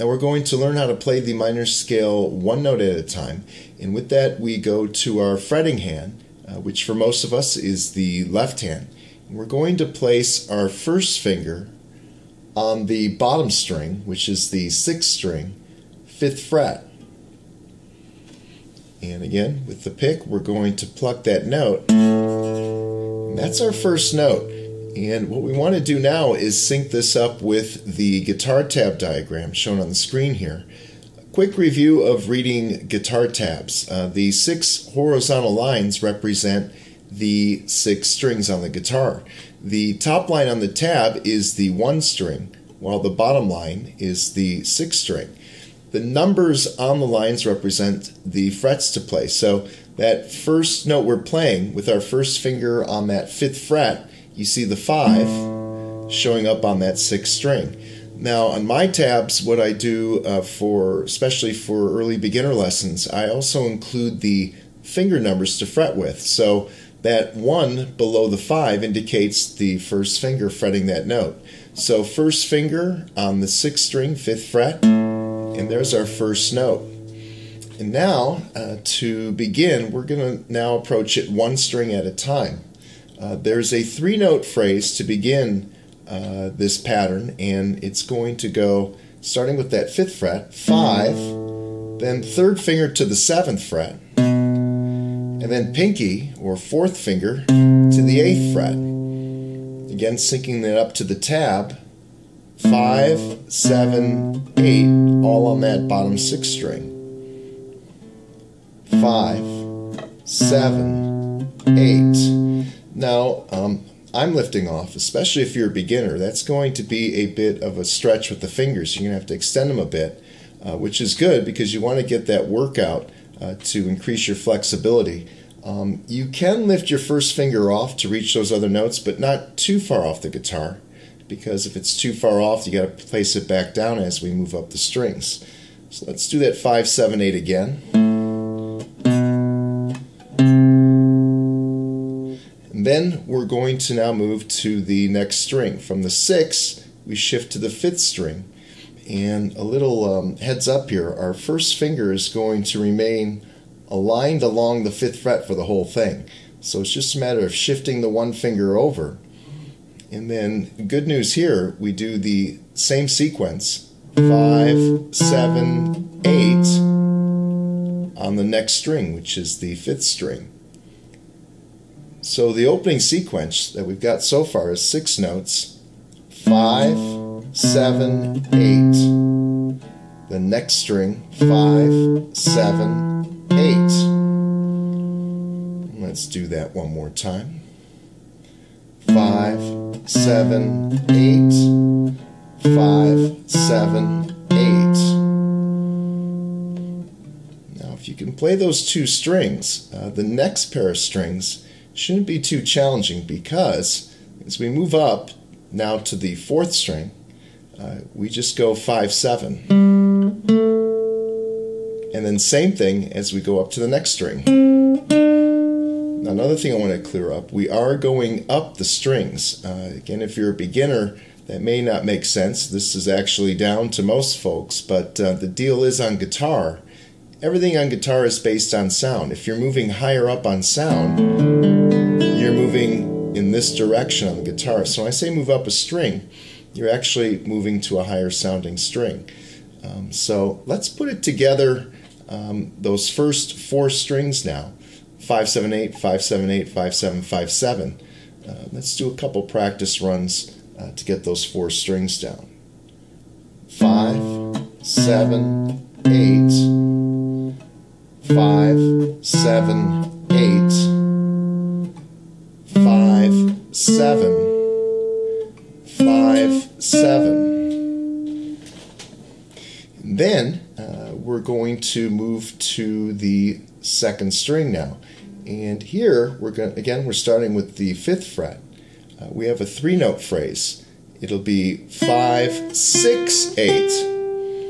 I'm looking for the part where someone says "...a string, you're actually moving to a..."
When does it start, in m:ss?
3:55.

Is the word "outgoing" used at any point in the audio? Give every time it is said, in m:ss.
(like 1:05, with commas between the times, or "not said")
not said.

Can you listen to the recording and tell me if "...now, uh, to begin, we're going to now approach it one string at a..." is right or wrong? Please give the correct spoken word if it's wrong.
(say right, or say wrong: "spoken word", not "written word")
right.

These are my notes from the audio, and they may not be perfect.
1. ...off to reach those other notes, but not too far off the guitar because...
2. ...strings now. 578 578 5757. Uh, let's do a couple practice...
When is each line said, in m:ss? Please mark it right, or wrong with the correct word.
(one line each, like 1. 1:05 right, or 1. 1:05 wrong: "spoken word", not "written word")
1. 2:07 right
2. 4:03 right.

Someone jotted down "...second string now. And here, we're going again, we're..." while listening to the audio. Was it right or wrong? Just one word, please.
right.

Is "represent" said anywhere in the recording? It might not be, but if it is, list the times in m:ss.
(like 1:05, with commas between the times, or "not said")
0:36, 0:47.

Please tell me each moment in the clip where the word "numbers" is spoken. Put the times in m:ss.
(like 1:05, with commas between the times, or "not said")
0:46, 1:05.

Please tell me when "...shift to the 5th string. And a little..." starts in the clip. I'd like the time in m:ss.
2:27.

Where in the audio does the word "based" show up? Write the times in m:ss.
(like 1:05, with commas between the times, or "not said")
3:48.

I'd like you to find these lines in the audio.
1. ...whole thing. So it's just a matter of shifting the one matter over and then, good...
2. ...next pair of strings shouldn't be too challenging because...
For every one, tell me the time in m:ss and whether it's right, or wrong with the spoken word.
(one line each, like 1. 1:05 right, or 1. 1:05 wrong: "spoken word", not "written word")
1. 2:35 wrong: "finger", not "matter"
2. 3:20 right.